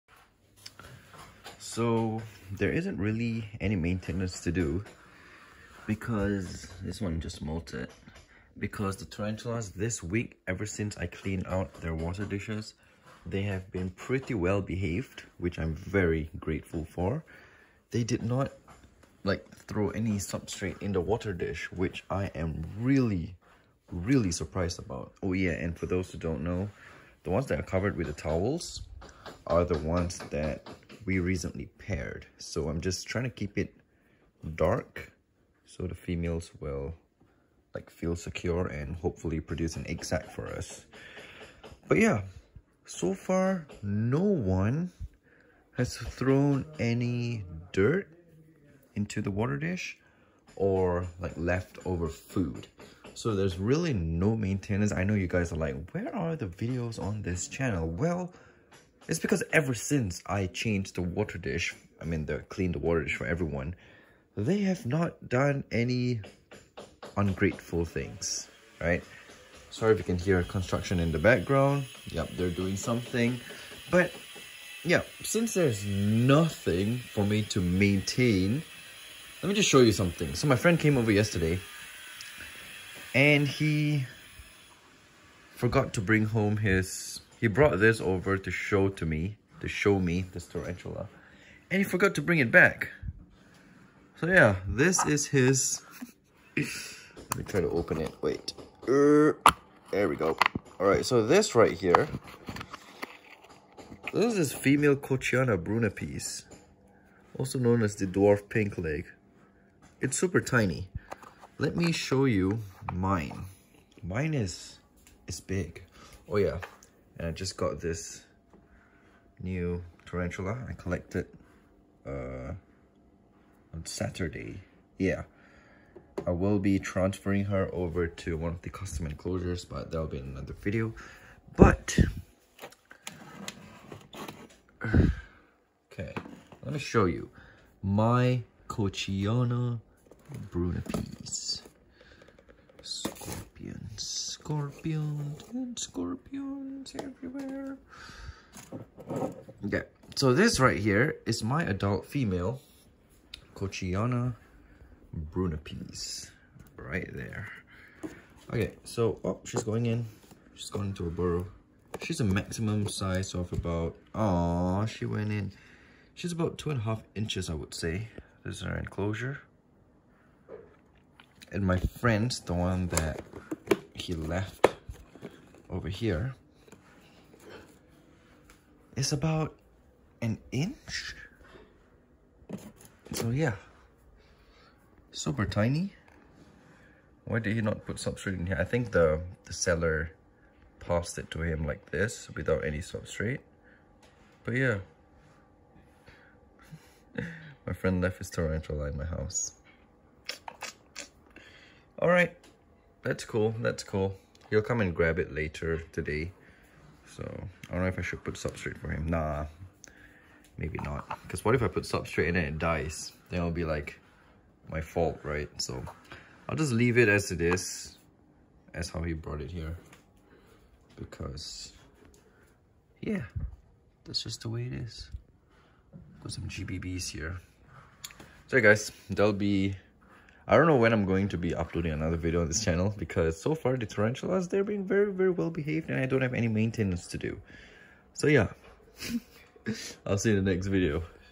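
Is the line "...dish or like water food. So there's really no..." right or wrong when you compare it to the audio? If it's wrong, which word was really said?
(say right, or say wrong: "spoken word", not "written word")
wrong: "leftover", not "water".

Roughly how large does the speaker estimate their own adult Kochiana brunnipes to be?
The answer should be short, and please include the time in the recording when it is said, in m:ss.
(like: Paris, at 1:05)
2.5 inches, at 2:46.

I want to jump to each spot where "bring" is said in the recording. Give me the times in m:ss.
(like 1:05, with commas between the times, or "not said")
1:26, 1:32.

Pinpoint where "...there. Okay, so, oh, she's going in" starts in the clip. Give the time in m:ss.
2:37.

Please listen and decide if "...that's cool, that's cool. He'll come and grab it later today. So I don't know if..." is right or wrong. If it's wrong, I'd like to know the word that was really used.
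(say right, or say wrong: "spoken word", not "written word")
right.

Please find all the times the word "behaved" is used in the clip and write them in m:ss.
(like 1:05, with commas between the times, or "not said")
0:14, 3:55.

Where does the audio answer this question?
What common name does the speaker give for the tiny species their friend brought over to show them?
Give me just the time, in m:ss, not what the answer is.
1:48.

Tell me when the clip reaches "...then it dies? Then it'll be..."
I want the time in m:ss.
3:32.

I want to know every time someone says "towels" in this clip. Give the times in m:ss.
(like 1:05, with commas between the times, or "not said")
0:28.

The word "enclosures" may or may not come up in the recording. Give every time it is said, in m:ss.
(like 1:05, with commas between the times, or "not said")
2:09, 2:48.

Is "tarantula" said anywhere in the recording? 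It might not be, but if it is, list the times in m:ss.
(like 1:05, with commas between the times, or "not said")
0:09, 1:30, 2:00, 3:18, 3:53.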